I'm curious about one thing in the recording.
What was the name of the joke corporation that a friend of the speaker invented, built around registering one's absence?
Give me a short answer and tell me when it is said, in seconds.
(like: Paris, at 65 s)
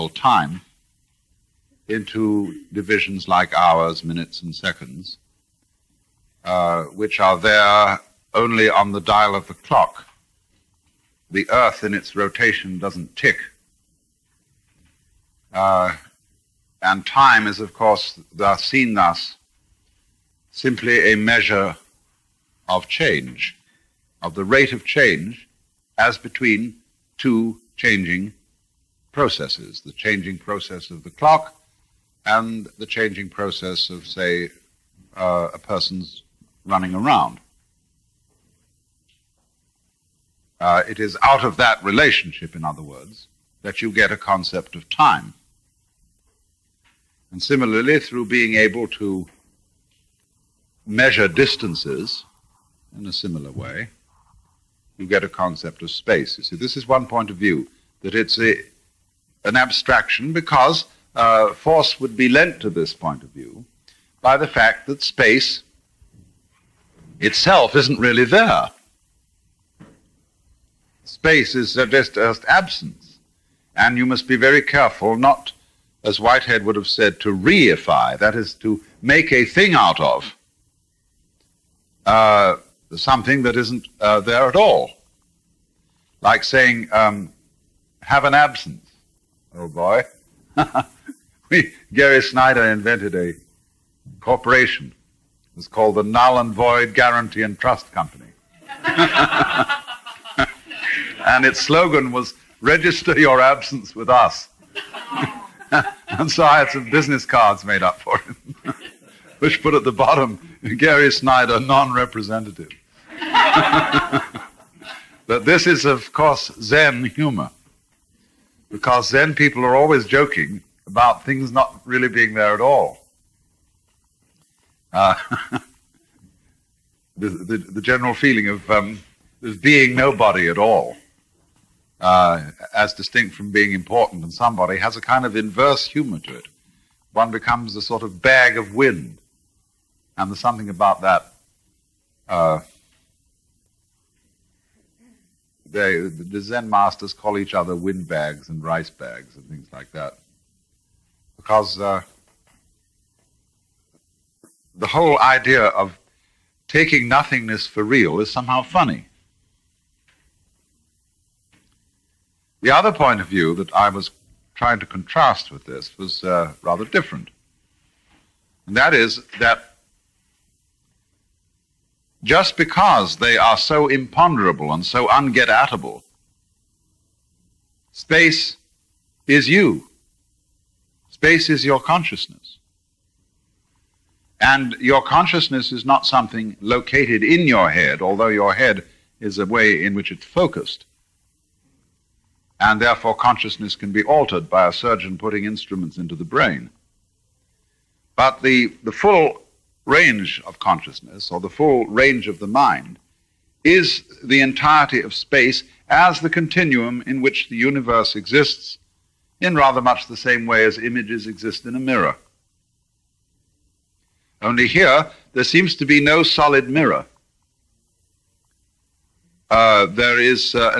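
Null and Void Guarantee and Trust Company, at 96 s.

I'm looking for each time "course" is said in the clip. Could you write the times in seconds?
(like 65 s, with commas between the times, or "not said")
17 s, 116 s.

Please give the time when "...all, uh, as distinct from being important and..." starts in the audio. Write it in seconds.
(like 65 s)
130 s.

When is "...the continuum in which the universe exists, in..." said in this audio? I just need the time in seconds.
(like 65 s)
206 s.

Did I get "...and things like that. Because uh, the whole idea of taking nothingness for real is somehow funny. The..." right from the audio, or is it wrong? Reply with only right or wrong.
right.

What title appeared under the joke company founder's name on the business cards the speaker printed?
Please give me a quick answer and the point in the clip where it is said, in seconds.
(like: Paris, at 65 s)
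non representative, at 111 s.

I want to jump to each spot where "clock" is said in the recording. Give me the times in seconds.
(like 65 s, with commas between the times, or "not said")
9 s, 31 s.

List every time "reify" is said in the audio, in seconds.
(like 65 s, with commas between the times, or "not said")
77 s.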